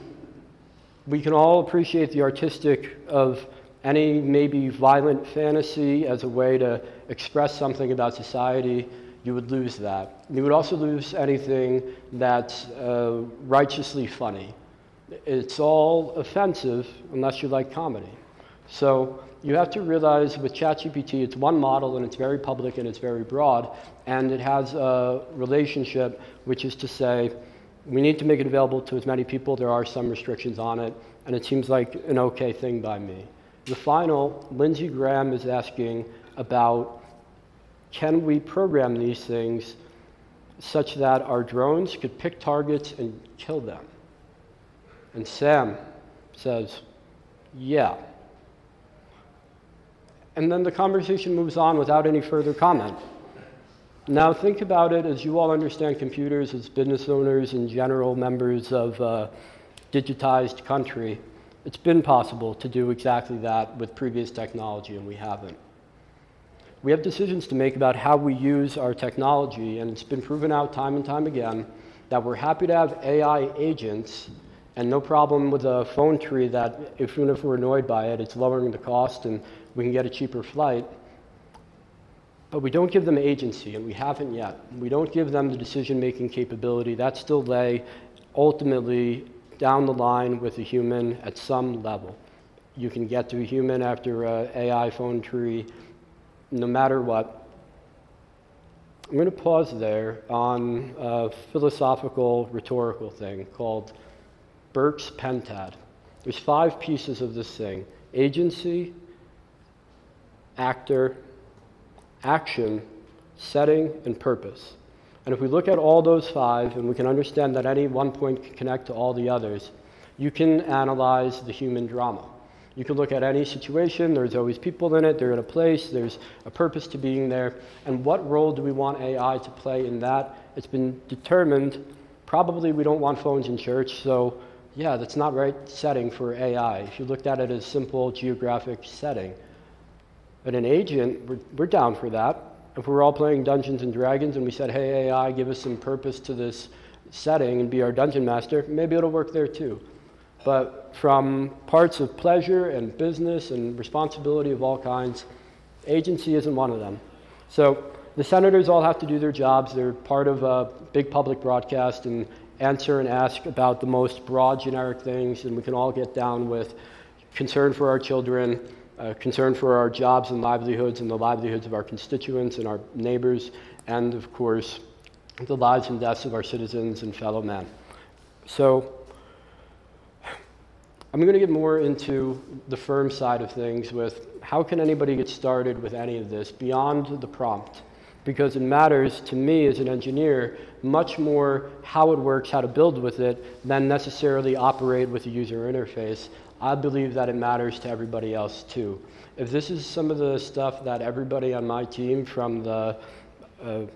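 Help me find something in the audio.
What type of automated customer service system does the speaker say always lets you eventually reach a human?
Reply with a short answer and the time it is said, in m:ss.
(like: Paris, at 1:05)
AI phone tree, at 1:34.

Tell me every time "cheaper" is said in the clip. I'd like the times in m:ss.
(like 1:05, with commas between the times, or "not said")
1:20.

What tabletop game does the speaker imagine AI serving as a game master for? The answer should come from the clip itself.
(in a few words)
Dungeons and Dragons.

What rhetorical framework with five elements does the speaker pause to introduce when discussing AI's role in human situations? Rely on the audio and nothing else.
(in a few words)
Burke's Pentad.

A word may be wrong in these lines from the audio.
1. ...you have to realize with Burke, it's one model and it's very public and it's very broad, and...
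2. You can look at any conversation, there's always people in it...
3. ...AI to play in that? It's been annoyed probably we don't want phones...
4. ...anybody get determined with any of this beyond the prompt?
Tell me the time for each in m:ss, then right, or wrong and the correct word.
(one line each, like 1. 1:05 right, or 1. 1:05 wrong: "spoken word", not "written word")
1. 0:19 wrong: "ChatGPT", not "Burke"
2. 2:02 wrong: "situation", not "conversation"
3. 2:08 wrong: "determined", not "annoyed"
4. 3:04 wrong: "started", not "determined".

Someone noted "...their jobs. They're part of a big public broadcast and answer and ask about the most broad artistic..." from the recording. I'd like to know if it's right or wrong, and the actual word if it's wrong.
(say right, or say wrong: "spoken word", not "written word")
wrong: "generic", not "artistic".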